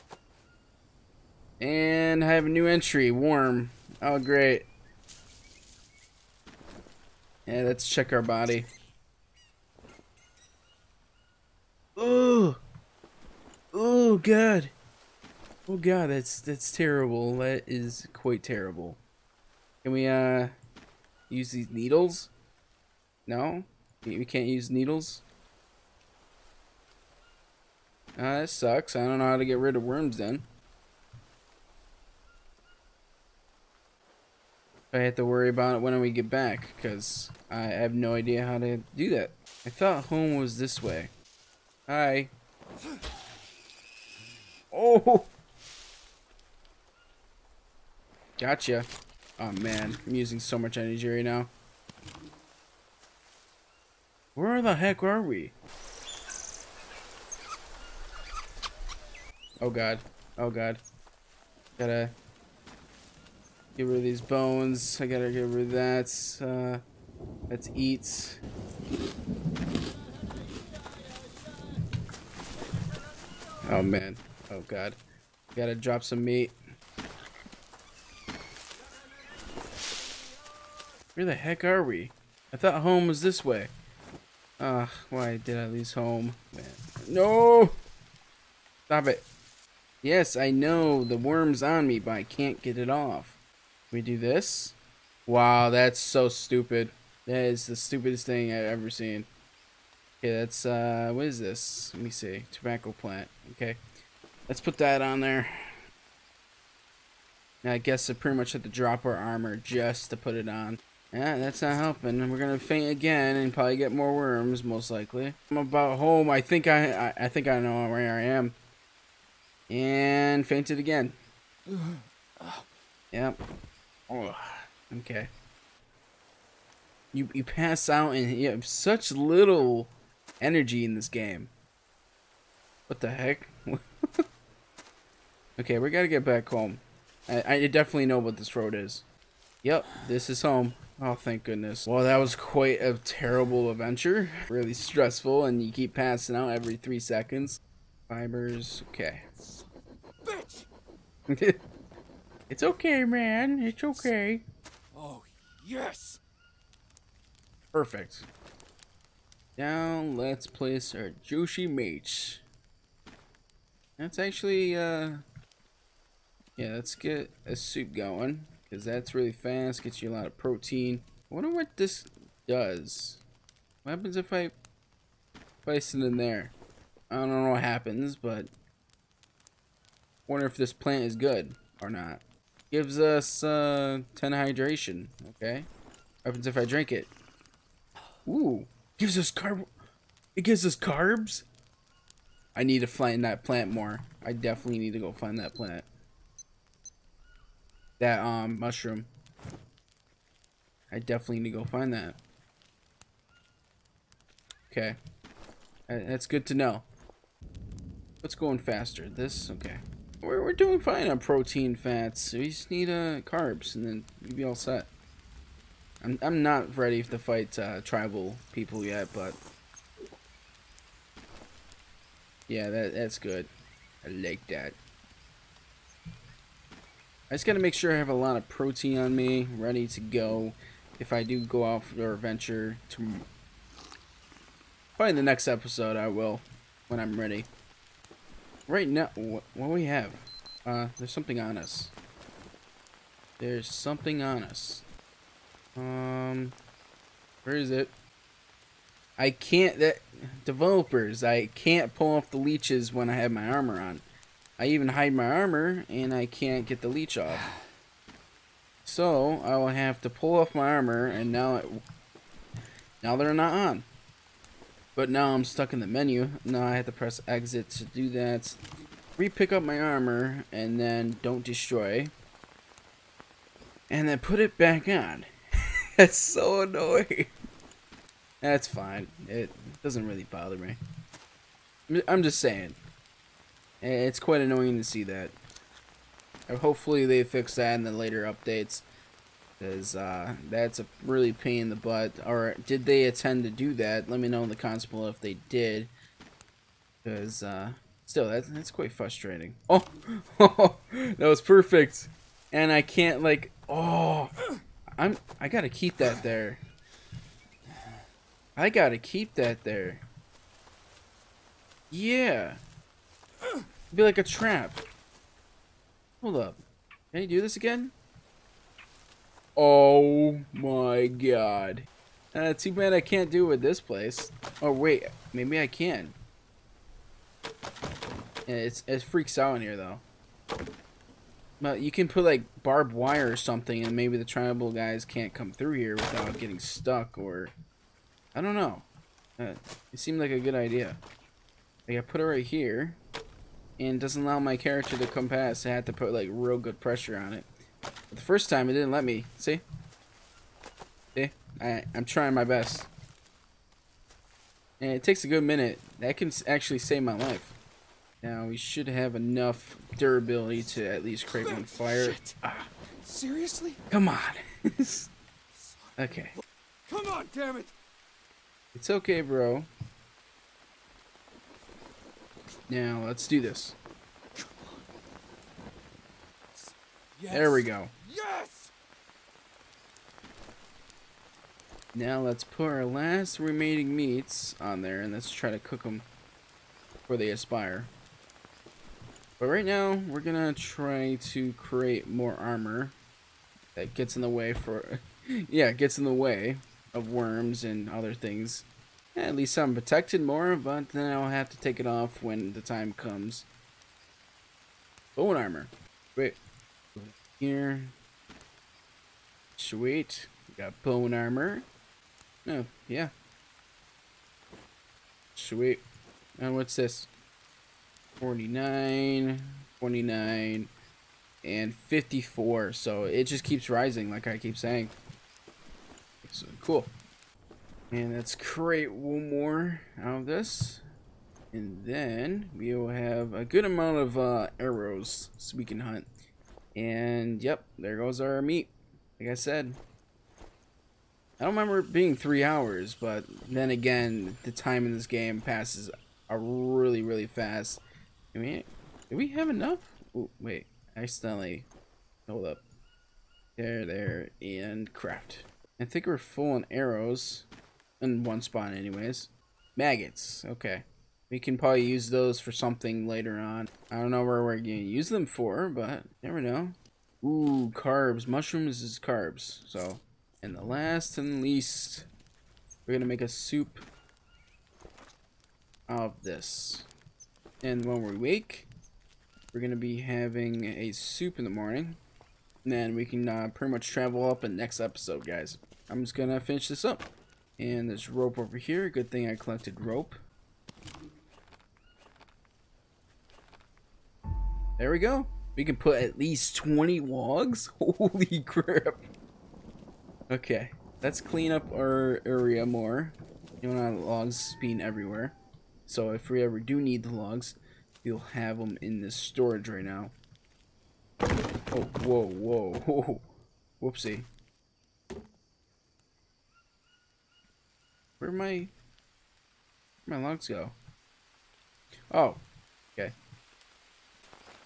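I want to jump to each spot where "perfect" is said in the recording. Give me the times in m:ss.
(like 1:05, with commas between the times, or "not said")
2:37, 5:01.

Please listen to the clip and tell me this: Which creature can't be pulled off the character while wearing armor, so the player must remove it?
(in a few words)
Leeches.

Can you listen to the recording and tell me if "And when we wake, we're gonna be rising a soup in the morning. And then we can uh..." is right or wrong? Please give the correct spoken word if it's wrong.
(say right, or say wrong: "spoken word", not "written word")
wrong: "having", not "rising".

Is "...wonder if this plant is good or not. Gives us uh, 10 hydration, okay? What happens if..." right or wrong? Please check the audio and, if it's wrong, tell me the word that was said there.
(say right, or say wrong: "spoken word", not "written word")
right.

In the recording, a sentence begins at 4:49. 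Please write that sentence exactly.
Because uh, that's a really pain in the butt.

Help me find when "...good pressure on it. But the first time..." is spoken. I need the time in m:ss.
5:46.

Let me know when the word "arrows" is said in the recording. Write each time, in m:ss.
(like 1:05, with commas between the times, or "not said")
7:14, 7:36.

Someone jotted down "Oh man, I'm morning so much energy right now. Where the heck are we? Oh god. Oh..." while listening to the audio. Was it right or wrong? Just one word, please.
wrong.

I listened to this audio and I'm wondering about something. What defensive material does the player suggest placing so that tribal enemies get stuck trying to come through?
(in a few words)
Barbed wire.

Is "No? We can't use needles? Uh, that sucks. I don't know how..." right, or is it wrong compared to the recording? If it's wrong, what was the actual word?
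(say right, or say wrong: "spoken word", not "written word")
right.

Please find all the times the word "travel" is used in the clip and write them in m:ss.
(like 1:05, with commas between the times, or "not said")
8:03.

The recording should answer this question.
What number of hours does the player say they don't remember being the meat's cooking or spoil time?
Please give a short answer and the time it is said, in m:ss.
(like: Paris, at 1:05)
3, at 7:22.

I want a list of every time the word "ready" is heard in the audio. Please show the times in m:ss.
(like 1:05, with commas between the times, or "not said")
3:36, 3:49, 3:57.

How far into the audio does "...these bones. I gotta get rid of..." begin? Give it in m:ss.
1:04.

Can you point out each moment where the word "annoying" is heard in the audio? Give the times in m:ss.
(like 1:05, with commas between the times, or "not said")
4:36, 4:44.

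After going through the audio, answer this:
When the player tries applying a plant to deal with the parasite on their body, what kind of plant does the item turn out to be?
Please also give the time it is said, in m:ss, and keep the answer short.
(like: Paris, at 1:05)
Tobacco plant, at 1:42.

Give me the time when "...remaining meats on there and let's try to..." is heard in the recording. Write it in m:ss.
6:23.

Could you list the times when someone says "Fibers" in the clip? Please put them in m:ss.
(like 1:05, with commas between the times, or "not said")
2:28.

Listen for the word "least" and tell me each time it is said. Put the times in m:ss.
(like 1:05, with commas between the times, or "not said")
6:01, 6:39, 7:51, 8:16.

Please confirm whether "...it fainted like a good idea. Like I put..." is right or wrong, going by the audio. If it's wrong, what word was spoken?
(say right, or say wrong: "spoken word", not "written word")
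wrong: "seemed", not "fainted".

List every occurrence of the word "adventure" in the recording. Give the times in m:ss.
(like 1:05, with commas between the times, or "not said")
2:23.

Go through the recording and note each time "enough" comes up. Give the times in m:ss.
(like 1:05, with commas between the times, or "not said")
5:59, 7:29.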